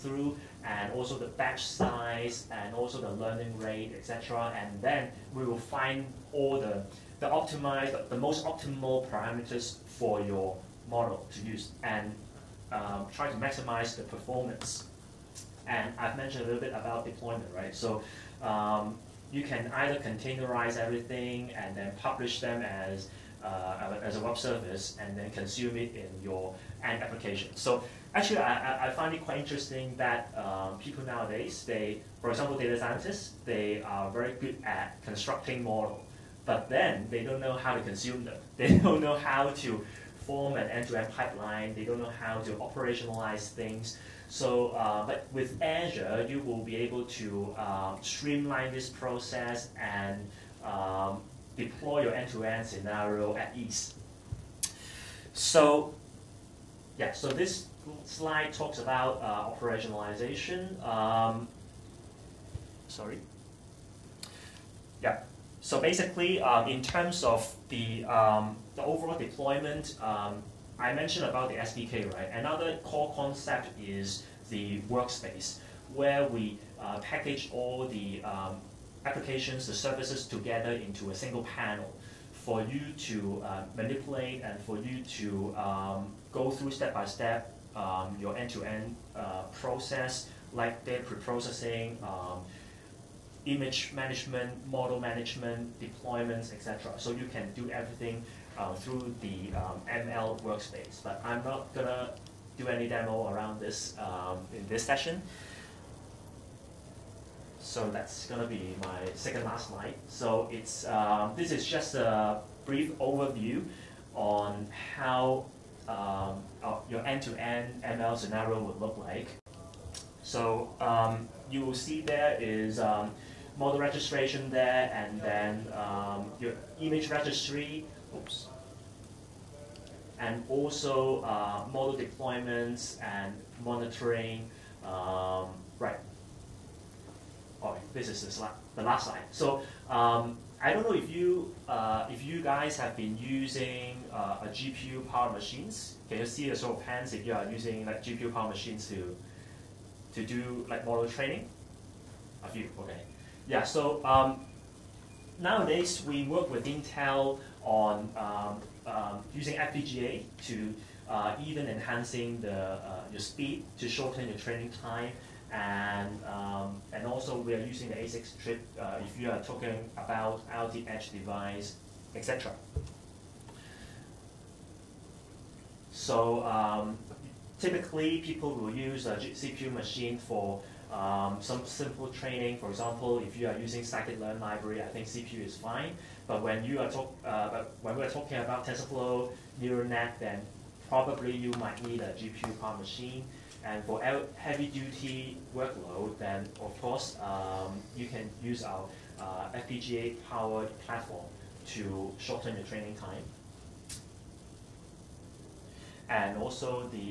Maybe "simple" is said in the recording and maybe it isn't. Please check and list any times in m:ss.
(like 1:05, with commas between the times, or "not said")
3:01.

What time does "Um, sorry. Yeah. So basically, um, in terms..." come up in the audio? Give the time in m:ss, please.
1:00.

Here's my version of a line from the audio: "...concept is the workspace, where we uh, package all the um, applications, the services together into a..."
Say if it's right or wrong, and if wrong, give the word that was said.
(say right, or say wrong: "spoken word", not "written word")
right.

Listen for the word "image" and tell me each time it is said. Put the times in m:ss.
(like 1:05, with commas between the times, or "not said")
1:33, 2:06.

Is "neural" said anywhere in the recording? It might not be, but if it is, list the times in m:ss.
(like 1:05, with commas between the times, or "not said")
3:09.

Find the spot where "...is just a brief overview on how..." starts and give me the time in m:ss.
1:51.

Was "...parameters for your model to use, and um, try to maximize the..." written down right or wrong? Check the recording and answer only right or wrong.
right.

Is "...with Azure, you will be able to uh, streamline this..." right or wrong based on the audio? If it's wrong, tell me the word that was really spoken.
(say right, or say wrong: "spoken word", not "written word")
right.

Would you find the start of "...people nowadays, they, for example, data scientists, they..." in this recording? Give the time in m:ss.
0:30.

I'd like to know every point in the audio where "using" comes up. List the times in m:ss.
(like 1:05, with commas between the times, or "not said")
2:23, 2:27, 2:39, 2:47, 3:03.